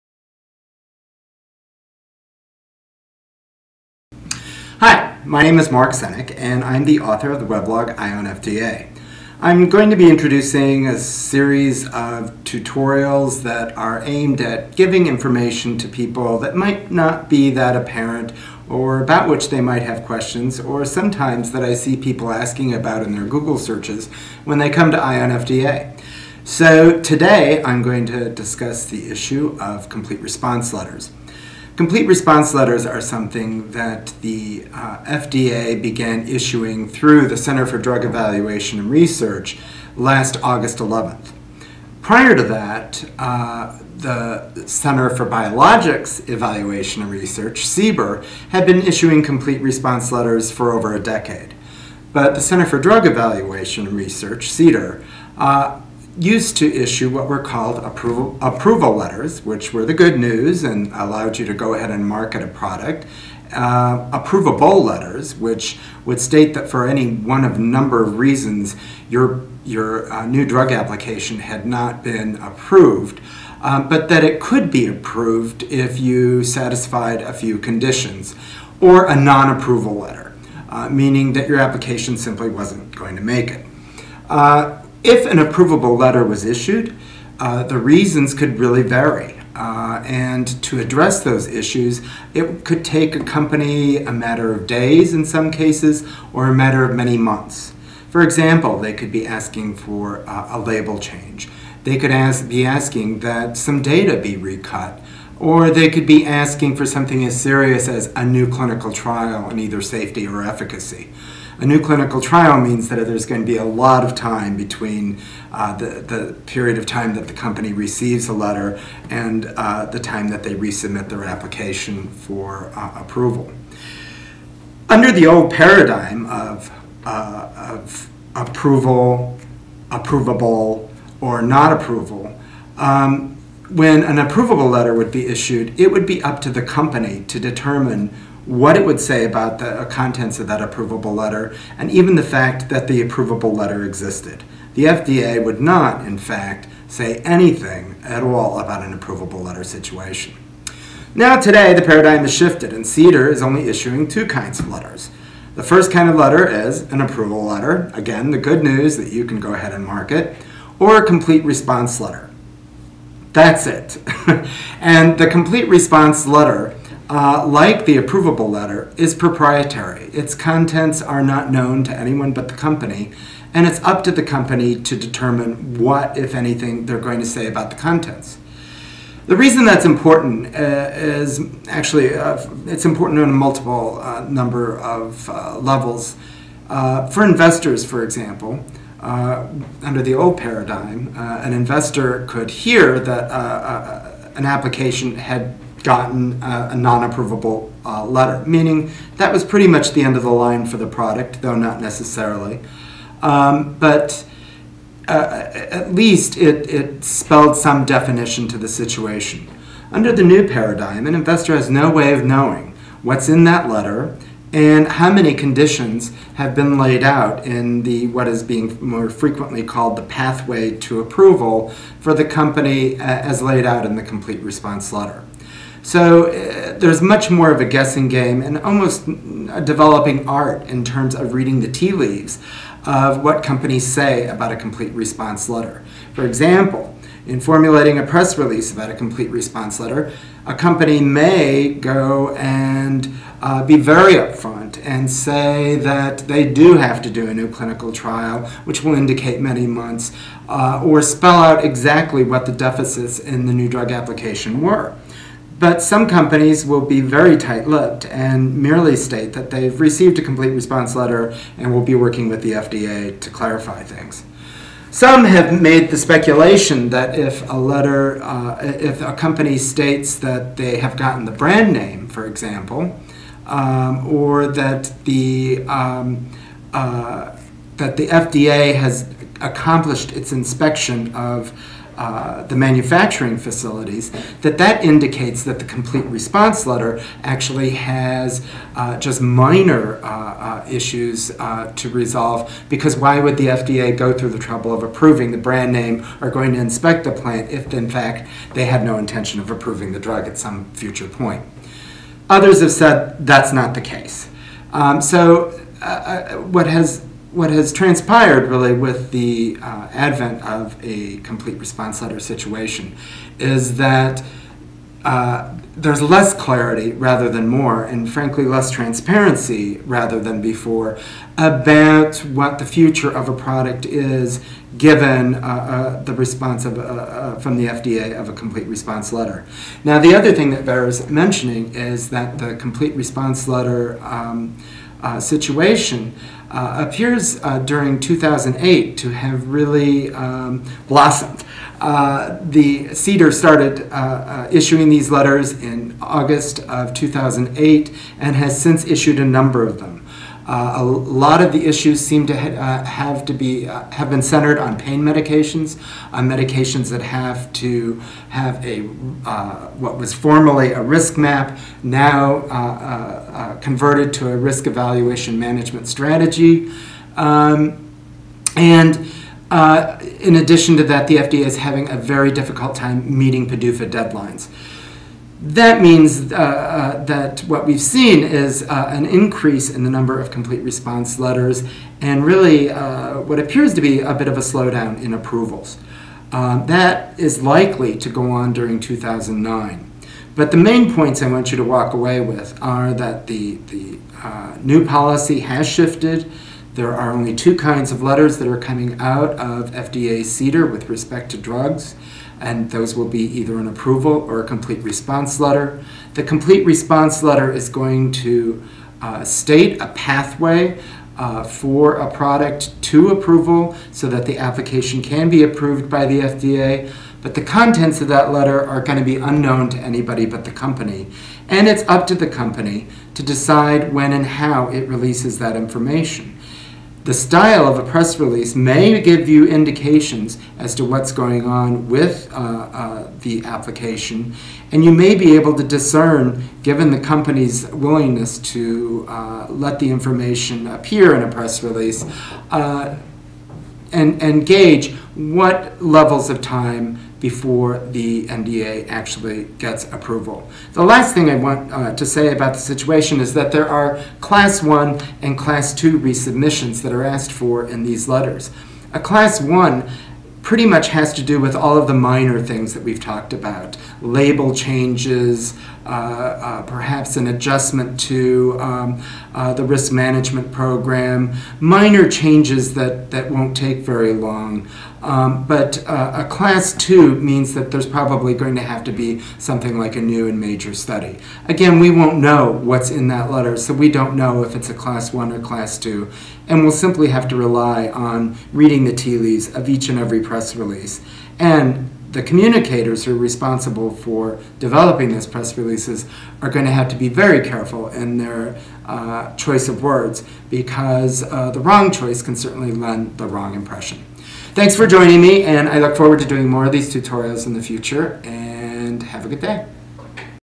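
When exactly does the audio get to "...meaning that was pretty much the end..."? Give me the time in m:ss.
3:18.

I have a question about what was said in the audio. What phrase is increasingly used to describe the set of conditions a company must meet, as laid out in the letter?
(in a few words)
pathway to approval.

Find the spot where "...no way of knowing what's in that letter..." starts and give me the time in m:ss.
3:31.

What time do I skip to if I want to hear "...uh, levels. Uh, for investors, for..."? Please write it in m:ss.
3:05.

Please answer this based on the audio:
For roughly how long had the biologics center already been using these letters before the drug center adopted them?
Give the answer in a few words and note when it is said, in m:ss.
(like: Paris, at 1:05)
over a decade, at 0:50.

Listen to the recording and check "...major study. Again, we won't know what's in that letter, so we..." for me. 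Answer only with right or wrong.
right.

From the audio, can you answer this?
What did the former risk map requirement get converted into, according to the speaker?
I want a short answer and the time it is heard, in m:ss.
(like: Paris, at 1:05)
risk evaluation management strategy, at 6:04.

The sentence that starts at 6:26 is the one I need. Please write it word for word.
Um, that is likely to go on during 2009.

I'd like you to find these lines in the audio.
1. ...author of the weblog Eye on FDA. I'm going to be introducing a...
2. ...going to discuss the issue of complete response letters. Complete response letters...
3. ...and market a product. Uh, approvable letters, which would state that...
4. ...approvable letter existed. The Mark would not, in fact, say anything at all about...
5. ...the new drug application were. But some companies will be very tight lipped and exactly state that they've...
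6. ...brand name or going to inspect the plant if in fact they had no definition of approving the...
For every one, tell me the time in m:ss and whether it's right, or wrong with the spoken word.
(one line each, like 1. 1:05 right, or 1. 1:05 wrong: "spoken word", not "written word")
1. 0:06 right
2. 0:27 right
3. 1:01 right
4. 2:23 wrong: "FDA", not "Mark"
5. 4:13 wrong: "merely", not "exactly"
6. 4:55 wrong: "intention", not "definition".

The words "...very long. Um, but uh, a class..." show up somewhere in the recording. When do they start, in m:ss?
7:53.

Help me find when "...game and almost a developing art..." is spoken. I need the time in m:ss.
3:48.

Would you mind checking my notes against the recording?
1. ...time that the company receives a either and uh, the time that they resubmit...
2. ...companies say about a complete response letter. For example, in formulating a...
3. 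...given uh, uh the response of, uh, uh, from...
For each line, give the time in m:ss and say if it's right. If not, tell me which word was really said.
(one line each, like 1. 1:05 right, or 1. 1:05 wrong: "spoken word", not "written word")
1. 1:56 wrong: "letter", not "either"
2. 3:53 right
3. 5:24 right.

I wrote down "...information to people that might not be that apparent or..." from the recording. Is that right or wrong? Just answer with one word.
right.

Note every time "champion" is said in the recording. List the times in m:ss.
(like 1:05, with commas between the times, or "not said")
not said.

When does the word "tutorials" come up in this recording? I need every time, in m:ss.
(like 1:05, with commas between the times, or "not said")
0:12, 8:26.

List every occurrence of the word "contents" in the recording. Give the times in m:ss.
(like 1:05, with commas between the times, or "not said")
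2:19, 2:50, 2:57, 6:57.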